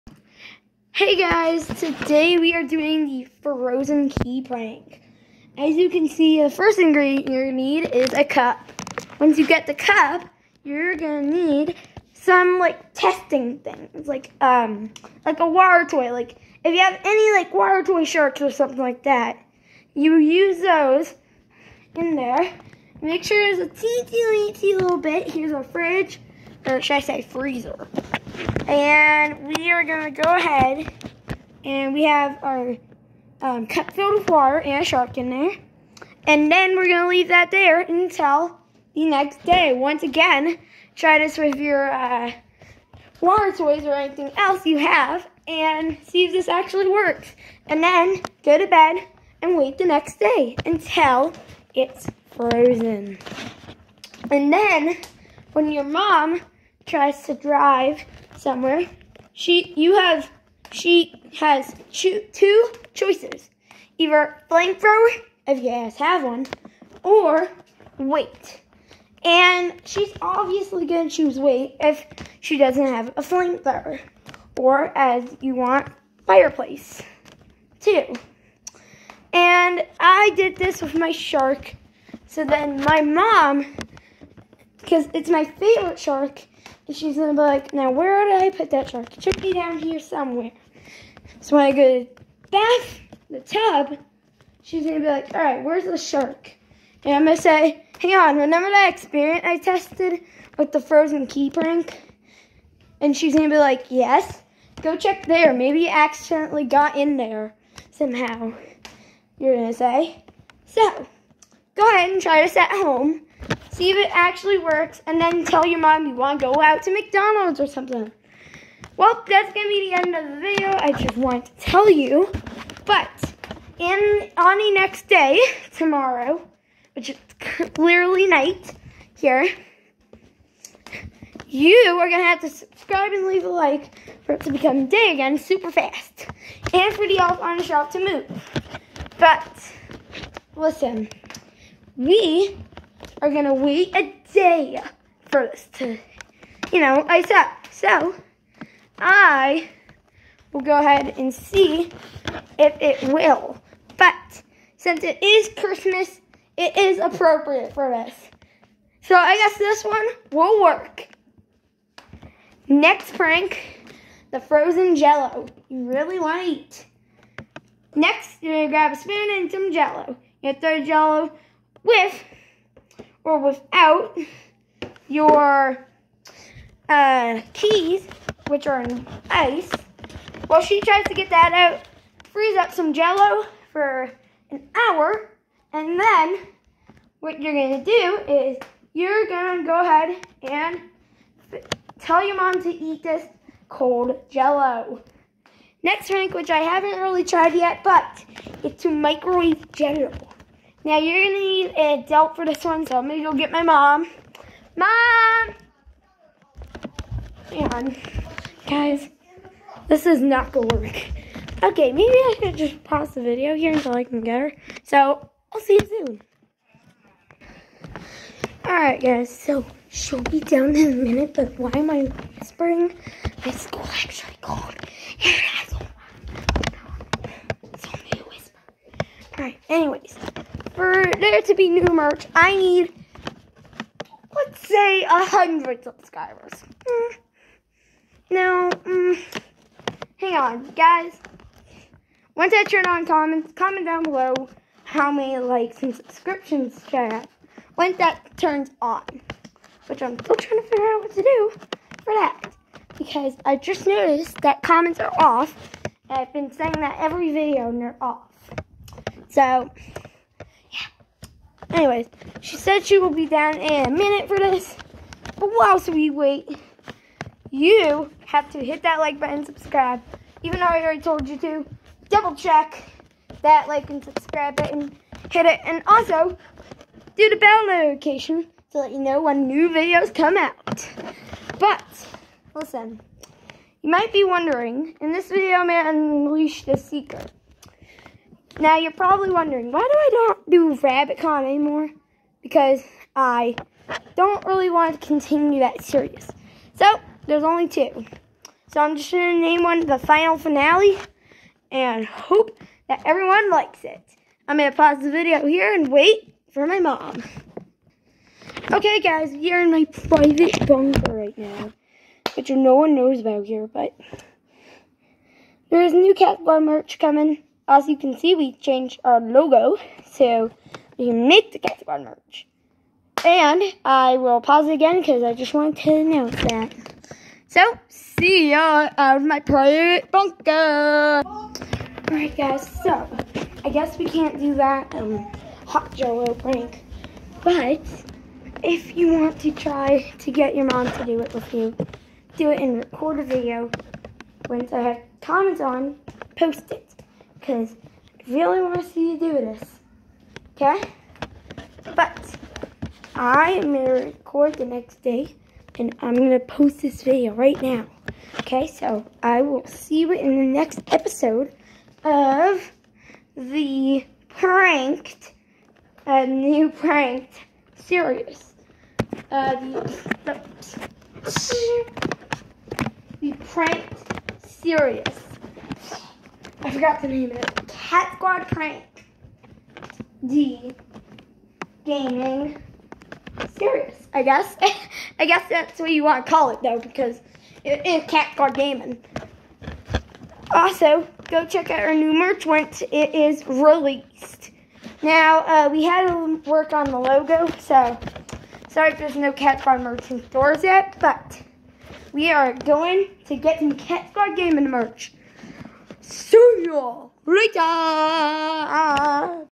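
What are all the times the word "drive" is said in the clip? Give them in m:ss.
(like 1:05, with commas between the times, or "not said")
0:57.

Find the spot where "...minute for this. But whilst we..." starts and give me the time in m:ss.
4:23.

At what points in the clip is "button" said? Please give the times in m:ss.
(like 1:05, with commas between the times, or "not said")
4:29, 4:34.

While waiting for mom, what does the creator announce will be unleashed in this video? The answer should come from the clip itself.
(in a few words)
The Seeker.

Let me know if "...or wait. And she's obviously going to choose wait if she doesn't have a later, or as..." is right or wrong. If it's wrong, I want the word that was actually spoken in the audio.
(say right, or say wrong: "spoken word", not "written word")
wrong: "flamethrower", not "later".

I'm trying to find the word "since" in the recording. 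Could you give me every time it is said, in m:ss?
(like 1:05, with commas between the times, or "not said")
2:34.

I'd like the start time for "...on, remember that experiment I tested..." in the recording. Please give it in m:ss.
1:38.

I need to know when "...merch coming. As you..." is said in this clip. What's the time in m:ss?
5:16.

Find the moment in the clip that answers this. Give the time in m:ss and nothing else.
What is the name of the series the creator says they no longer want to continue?
4:50.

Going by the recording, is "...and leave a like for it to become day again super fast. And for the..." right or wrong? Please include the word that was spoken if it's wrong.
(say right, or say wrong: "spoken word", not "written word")
right.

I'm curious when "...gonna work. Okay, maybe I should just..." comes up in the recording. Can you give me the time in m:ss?
3:30.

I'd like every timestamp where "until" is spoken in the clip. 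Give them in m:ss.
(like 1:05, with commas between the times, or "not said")
0:37, 0:50, 3:33.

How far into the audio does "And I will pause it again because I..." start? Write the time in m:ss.
5:23.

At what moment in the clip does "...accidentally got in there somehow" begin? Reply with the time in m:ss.
1:45.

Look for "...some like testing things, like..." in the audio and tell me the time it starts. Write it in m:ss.
0:12.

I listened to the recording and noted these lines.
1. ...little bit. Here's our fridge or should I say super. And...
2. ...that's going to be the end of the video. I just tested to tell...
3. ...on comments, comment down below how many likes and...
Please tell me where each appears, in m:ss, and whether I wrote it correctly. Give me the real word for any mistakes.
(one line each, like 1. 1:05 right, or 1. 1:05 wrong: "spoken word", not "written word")
1. 0:24 wrong: "freezer", not "super"
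2. 1:59 wrong: "wanted", not "tested"
3. 4:02 right.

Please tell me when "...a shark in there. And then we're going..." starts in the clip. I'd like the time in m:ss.
0:34.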